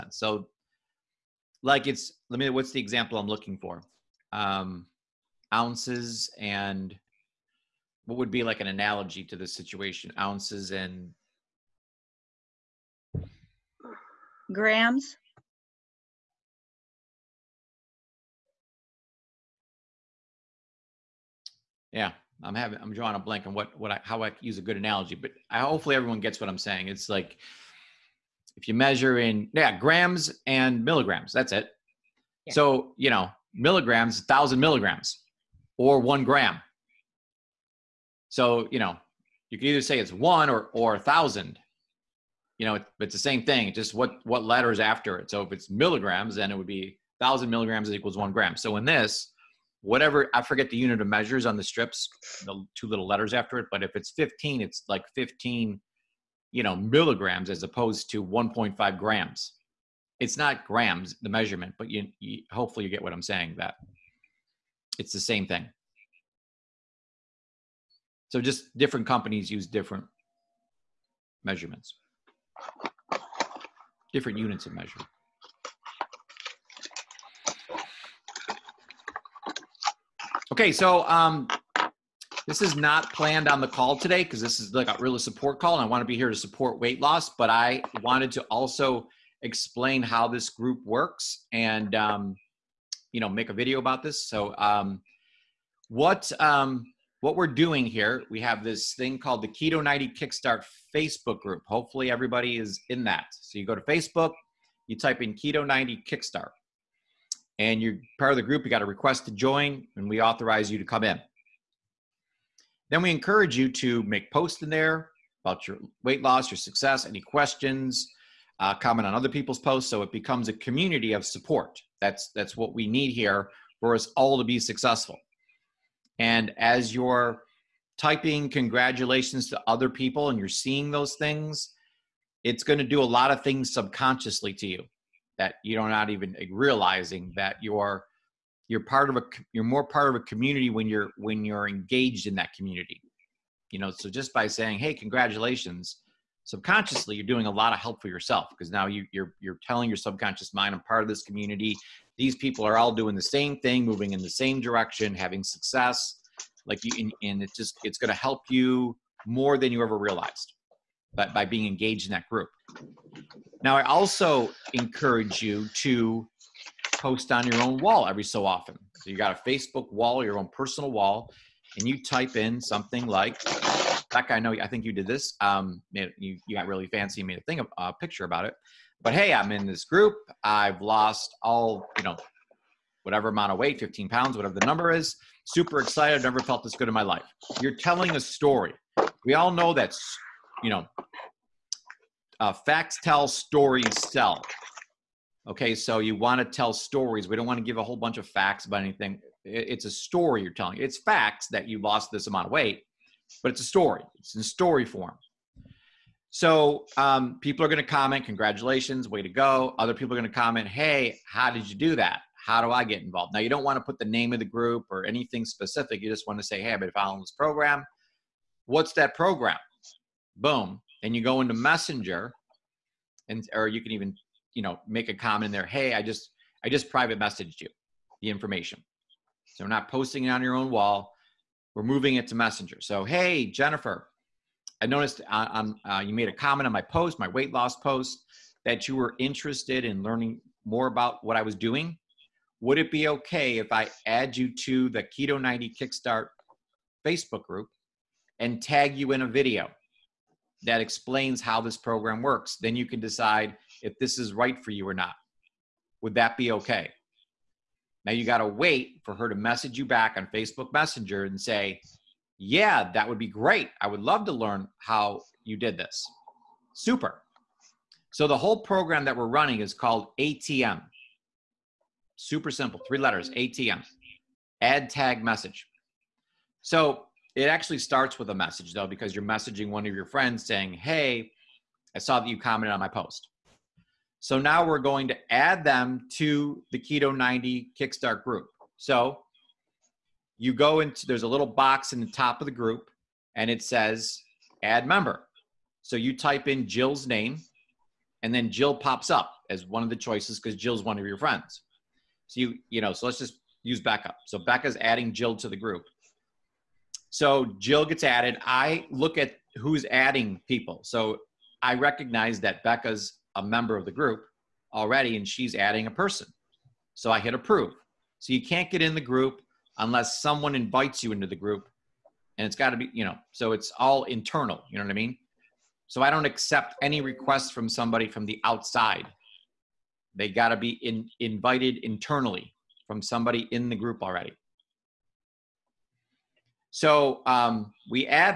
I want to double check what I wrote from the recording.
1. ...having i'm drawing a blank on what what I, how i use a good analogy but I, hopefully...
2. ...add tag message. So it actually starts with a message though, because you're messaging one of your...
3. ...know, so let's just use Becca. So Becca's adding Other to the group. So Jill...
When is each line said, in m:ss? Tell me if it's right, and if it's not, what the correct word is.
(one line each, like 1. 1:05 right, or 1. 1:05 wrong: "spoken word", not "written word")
1. 0:22 right
2. 4:34 right
3. 5:02 wrong: "Jill", not "Other".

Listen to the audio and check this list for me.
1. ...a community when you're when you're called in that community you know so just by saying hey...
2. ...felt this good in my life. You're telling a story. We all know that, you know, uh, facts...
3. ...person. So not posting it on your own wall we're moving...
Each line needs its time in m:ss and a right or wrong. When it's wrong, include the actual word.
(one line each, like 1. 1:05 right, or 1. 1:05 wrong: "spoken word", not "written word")
1. 2:20 wrong: "engaged", not "called"
2. 3:06 right
3. 3:48 wrong: "information", not "person".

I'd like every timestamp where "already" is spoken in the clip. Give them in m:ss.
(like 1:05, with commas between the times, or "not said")
5:14, 5:34.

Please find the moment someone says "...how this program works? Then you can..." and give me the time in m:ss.
4:11.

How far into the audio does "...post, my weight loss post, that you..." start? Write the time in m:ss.
3:56.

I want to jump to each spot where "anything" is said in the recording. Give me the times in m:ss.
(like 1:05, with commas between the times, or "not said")
3:18, 3:35.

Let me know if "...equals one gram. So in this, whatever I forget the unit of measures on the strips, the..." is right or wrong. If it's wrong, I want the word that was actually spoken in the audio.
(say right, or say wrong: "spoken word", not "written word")
right.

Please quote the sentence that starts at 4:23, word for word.
I would love to learn how you did this.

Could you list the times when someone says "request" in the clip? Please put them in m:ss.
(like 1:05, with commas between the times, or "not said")
1:48, 5:26.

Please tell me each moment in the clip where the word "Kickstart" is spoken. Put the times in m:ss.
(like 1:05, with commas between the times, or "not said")
1:40, 1:46, 4:05, 4:47.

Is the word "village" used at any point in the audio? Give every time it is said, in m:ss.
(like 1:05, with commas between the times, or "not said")
not said.